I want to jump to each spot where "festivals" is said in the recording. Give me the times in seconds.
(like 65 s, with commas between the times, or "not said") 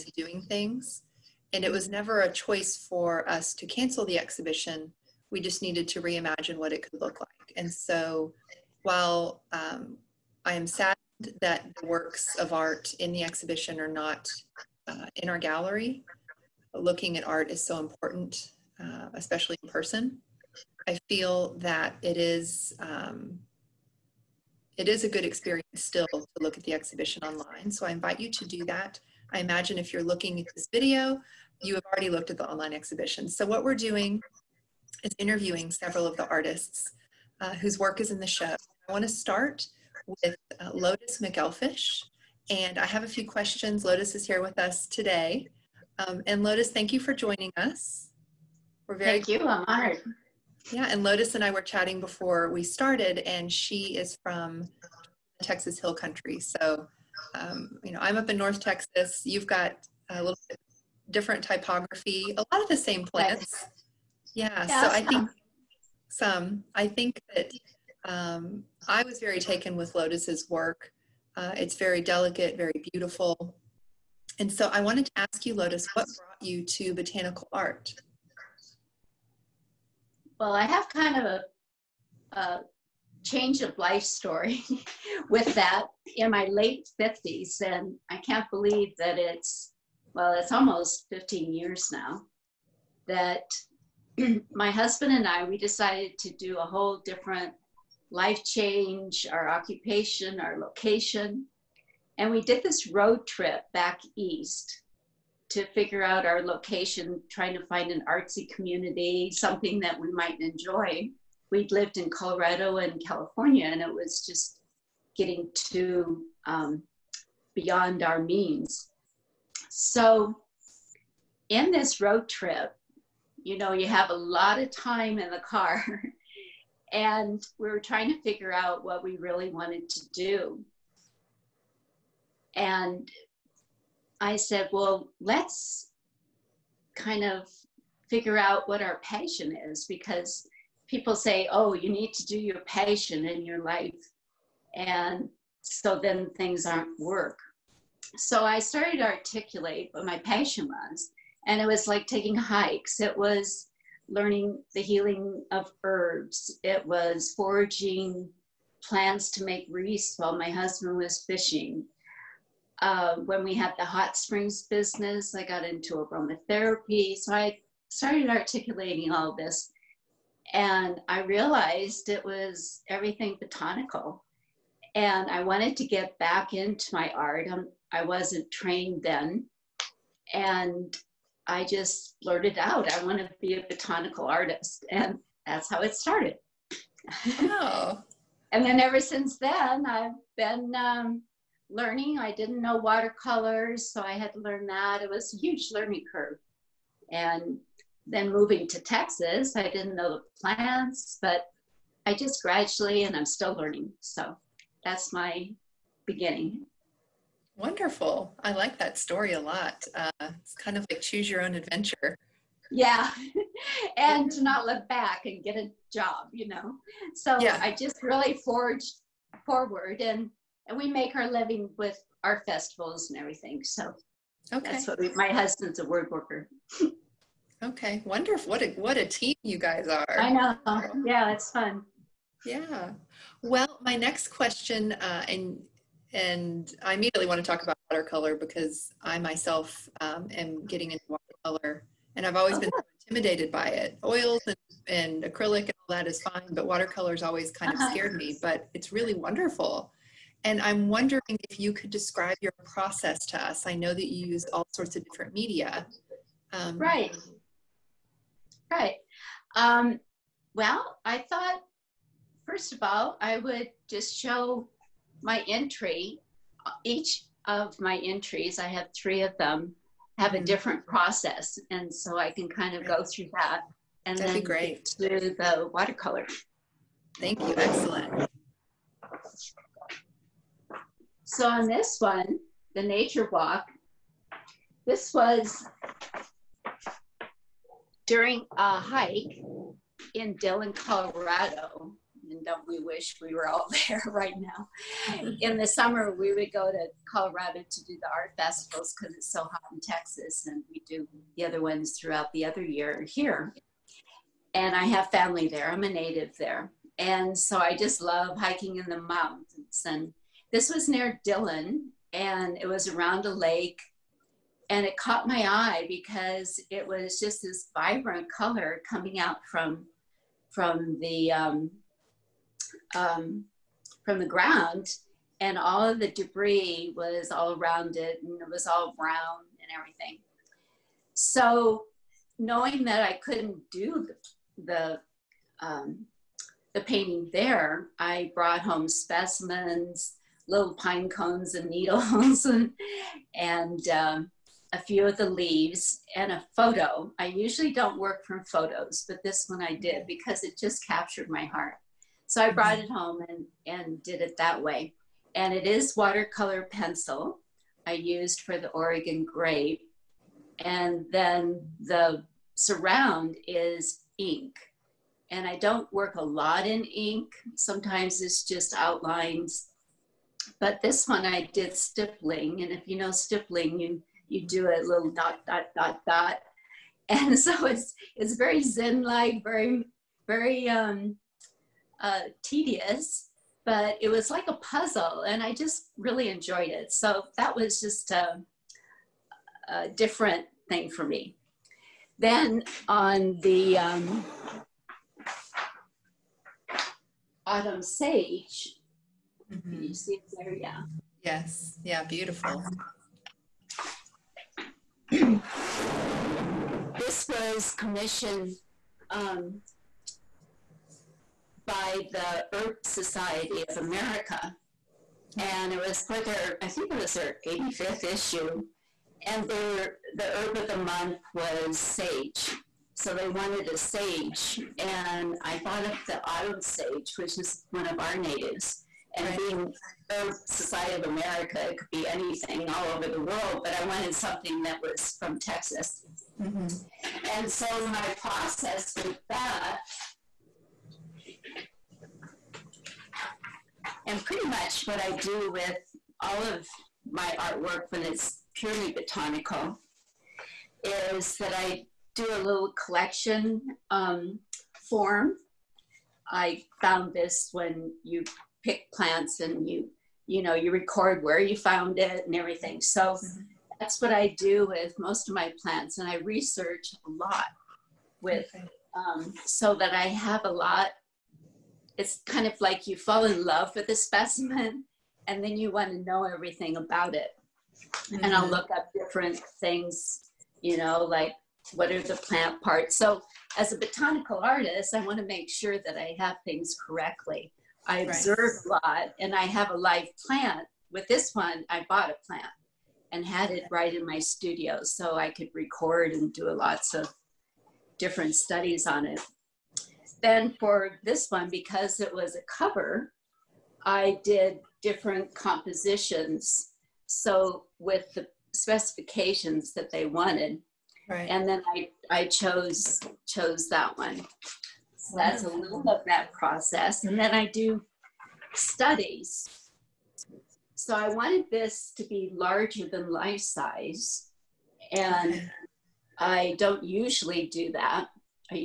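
222 s, 298 s.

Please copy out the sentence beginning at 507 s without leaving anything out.
So with the specifications that they wanted.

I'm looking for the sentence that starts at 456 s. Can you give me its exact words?
I found this when you pick plants and you you know you record where you found it and everything.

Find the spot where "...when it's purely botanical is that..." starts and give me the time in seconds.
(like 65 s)
447 s.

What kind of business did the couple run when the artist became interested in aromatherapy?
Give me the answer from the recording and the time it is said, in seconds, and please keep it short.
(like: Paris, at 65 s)
hot springs business, at 163 s.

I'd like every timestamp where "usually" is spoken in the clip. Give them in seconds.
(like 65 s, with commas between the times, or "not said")
347 s, 526 s.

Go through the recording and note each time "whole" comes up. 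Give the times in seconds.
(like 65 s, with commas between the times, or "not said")
96 s.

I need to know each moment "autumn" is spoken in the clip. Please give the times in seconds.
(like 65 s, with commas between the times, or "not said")
397 s, 426 s.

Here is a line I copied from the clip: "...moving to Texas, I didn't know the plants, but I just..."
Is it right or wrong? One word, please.
right.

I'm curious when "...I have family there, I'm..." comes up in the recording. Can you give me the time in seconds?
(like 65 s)
304 s.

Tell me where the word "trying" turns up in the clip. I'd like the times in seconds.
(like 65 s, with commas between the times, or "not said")
107 s, 127 s.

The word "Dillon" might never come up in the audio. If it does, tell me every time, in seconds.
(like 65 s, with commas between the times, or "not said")
290 s, 311 s.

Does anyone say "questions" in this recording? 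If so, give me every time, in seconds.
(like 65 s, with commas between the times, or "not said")
43 s, 234 s.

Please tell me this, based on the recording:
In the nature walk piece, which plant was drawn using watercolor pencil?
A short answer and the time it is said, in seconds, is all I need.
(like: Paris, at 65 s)
Oregon grape, at 358 s.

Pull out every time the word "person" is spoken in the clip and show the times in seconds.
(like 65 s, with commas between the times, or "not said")
19 s.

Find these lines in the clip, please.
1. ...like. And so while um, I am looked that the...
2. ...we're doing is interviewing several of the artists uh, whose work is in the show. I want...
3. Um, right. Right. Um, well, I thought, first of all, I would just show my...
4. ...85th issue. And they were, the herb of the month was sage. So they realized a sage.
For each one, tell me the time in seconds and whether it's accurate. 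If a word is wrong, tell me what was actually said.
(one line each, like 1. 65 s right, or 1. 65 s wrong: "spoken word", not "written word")
1. 7 s wrong: "saddened", not "looked"
2. 33 s right
3. 256 s right
4. 417 s wrong: "wanted", not "realized".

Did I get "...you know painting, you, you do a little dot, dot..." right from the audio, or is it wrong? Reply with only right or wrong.
wrong.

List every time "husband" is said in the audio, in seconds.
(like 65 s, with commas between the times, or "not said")
94 s, 160 s, 225 s.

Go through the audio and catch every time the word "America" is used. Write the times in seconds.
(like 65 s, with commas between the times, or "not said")
413 s, 431 s.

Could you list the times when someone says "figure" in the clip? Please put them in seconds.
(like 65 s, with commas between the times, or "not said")
105 s, 128 s, 138 s.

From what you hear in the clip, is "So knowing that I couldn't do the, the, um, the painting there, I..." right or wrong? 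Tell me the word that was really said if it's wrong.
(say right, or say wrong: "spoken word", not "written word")
right.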